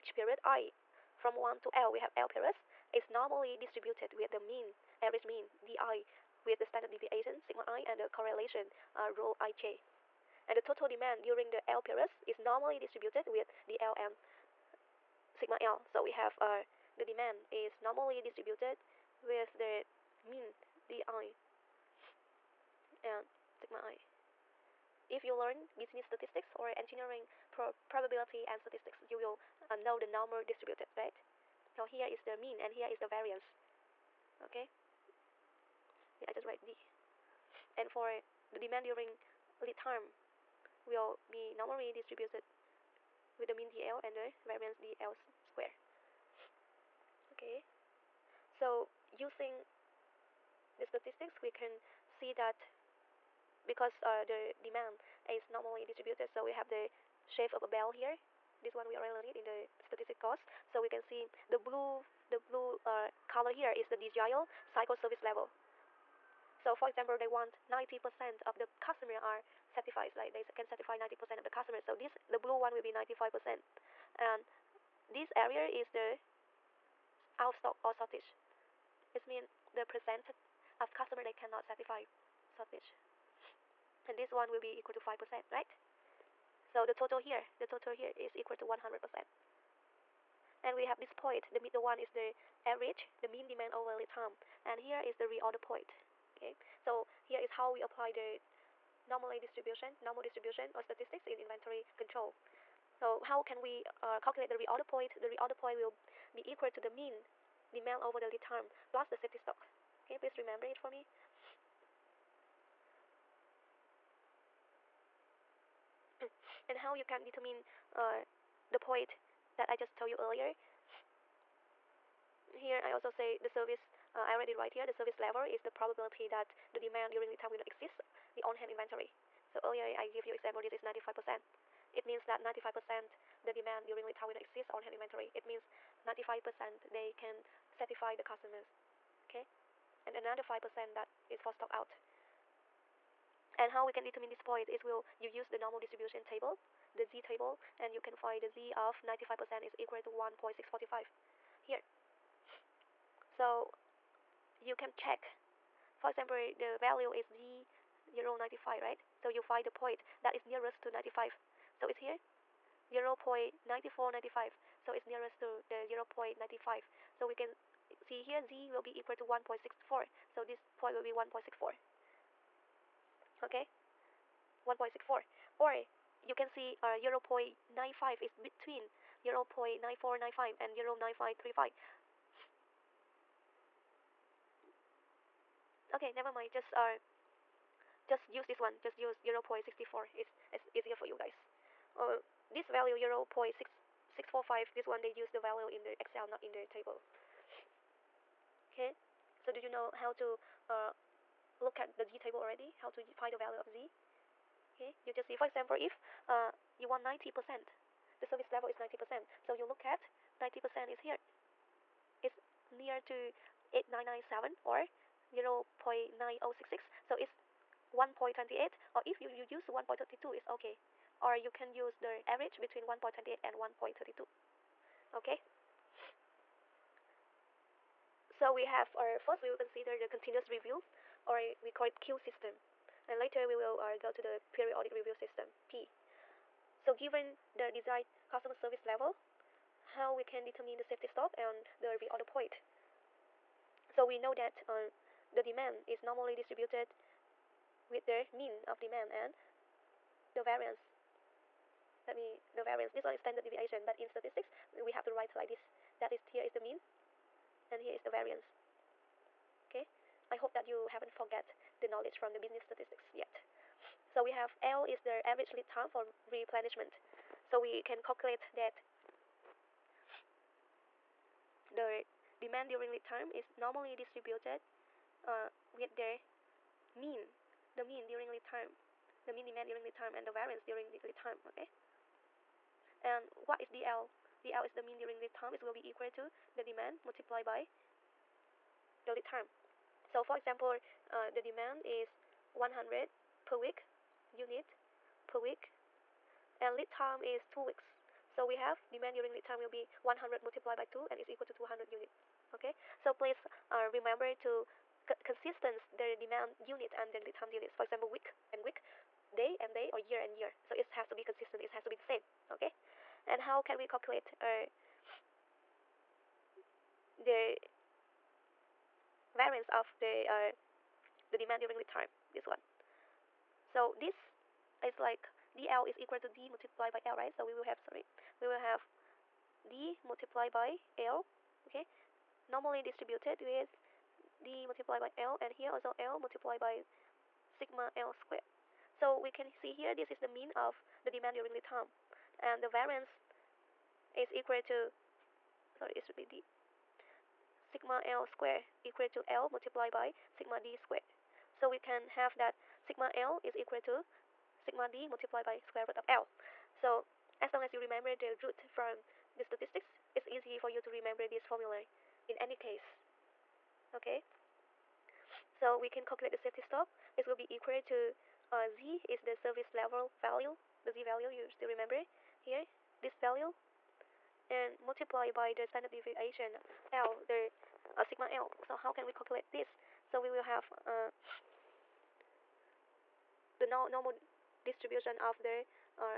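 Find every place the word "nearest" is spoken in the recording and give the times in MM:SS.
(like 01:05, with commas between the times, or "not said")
02:40.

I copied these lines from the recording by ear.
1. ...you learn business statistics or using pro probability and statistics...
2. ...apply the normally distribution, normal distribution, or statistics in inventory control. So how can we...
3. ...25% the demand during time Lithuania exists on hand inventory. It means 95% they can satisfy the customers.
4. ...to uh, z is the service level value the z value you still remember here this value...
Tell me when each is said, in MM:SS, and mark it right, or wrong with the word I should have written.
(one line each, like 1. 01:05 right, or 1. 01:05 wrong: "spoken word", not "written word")
1. 00:25 wrong: "engineering", not "using"
2. 01:37 right
3. 02:12 wrong: "95", not "25"
4. 06:07 right.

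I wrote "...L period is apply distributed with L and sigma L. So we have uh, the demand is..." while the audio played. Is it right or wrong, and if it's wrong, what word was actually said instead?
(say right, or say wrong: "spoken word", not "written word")
wrong: "normally", not "apply".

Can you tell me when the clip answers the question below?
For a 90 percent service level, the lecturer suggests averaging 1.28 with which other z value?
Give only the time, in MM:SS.
03:43.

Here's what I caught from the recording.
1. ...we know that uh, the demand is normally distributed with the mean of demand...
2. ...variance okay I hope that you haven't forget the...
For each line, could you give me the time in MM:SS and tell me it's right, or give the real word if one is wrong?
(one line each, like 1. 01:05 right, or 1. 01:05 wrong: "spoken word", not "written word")
1. 04:04 right
2. 04:18 right.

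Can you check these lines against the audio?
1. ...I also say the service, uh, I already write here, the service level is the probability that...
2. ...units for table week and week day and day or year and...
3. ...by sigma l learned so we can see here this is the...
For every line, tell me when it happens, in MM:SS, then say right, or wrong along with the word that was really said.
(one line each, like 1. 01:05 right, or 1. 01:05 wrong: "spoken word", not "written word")
1. 02:02 right
2. 05:07 wrong: "example", not "table"
3. 05:36 wrong: "squared", not "learned".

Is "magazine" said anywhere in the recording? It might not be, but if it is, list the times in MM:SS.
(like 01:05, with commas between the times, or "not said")
not said.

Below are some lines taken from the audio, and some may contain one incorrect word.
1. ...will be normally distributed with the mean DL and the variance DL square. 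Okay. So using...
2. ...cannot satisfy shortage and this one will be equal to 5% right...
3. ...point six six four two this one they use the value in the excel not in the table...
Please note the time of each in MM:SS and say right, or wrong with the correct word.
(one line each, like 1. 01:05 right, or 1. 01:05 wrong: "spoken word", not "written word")
1. 00:40 right
2. 01:21 right
3. 03:13 wrong: "five", not "two".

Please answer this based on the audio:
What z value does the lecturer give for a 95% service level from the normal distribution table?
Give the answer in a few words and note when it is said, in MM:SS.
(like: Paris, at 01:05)
1.645, at 02:30.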